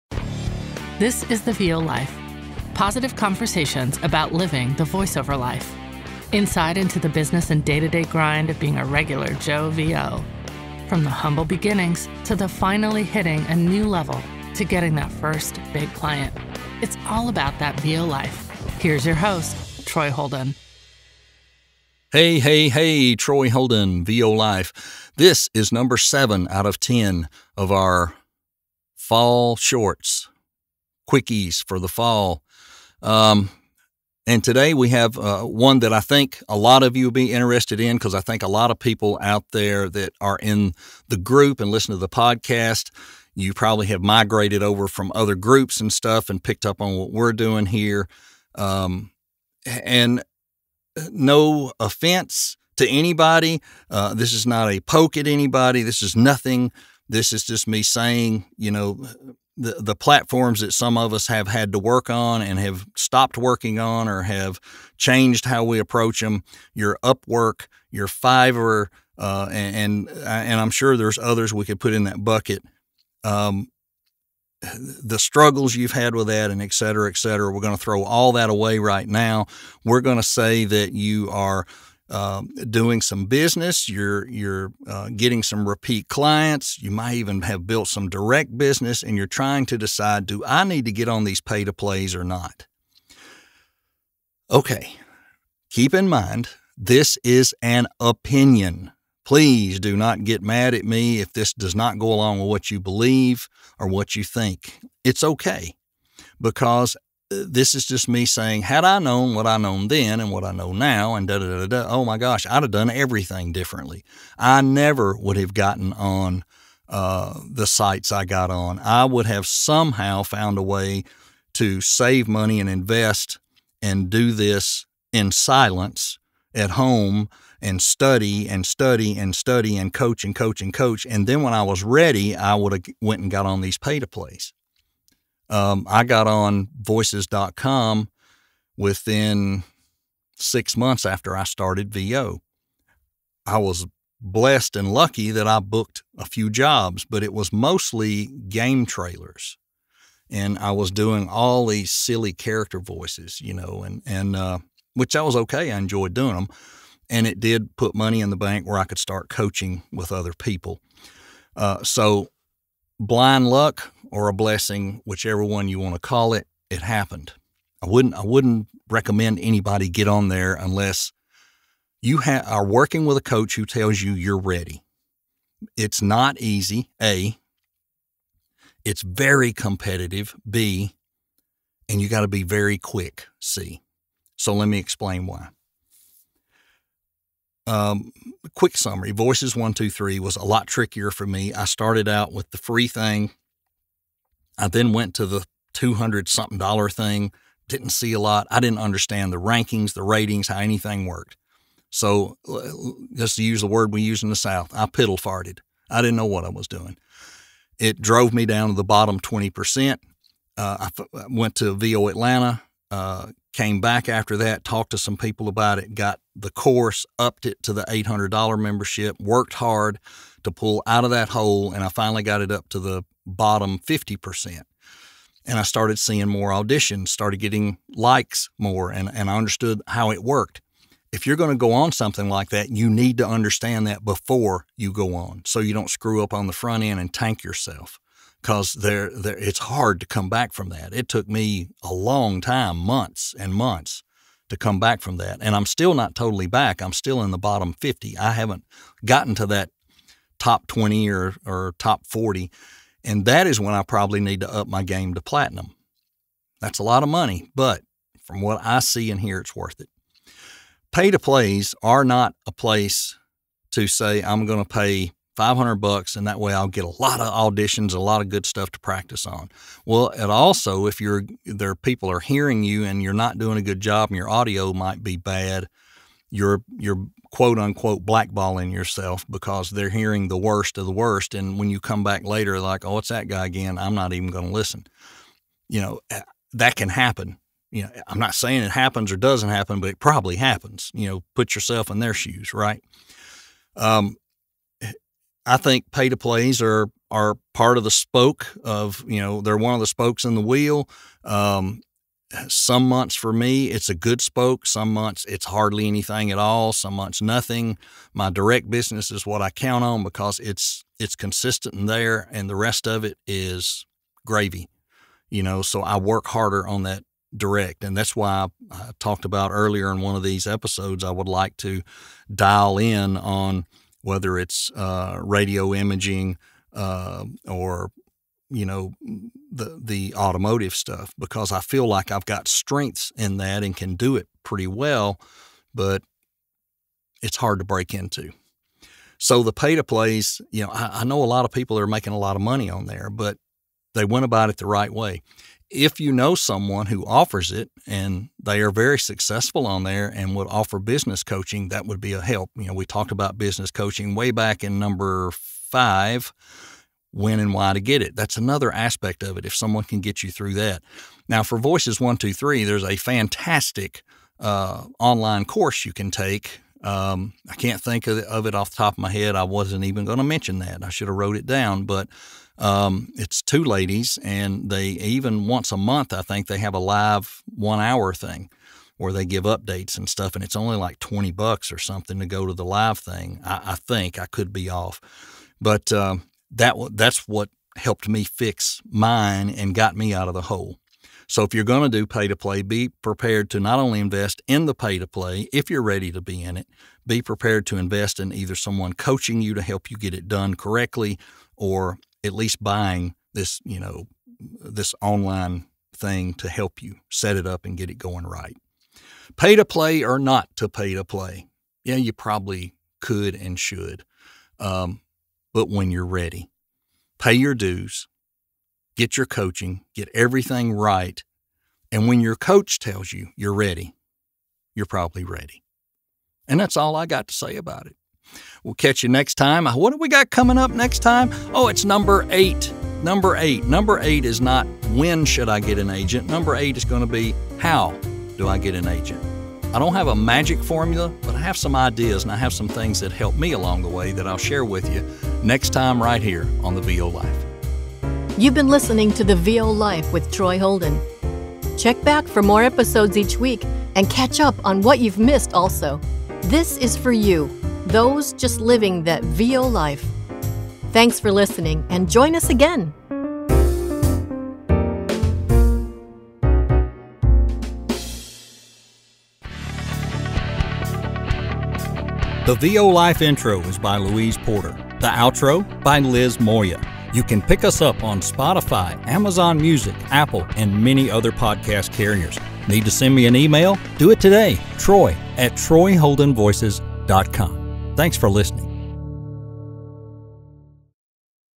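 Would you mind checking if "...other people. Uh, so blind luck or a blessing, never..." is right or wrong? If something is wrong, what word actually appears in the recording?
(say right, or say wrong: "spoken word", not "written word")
wrong: "whichever", not "never".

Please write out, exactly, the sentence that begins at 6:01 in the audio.
Now, for Voices 123, there's a fantastic uh, online course you can take.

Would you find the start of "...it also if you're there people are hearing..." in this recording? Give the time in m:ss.
4:30.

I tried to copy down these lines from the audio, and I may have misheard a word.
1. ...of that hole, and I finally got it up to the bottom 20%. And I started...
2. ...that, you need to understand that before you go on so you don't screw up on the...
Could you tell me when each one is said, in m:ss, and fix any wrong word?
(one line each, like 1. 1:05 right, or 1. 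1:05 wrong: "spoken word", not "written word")
1. 3:41 wrong: "50", not "20"
2. 3:52 right.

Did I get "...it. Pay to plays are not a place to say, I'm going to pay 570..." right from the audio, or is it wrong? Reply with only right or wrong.
wrong.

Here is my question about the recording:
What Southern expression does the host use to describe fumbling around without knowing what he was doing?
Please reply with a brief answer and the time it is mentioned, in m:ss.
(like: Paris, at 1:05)
piddle farted, at 3:24.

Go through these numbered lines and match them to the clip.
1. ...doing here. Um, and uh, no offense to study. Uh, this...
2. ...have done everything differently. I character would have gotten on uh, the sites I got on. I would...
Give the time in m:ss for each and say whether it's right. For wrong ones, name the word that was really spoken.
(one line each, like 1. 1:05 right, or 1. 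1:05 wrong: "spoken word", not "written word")
1. 0:47 wrong: "anybody", not "study"
2. 1:52 wrong: "never", not "character".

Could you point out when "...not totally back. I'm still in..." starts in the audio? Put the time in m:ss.
4:05.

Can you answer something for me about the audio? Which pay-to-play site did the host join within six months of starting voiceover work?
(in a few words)
voices.com.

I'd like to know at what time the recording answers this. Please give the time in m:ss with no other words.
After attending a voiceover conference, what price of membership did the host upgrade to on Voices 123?
3:37.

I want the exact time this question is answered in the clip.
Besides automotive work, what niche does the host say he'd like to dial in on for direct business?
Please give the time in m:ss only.
5:25.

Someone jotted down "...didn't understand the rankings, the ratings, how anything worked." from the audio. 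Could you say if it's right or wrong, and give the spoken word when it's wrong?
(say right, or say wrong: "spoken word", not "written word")
right.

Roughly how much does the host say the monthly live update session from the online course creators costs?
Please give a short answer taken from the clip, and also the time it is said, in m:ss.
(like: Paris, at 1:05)
$20, at 6:20.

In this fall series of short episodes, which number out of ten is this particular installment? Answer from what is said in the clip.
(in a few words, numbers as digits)
7.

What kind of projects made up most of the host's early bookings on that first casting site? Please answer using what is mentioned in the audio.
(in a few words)
Game trailers.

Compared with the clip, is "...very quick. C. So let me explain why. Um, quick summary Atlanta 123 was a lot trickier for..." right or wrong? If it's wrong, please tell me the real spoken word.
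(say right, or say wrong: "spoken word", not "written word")
wrong: "Voices", not "Atlanta".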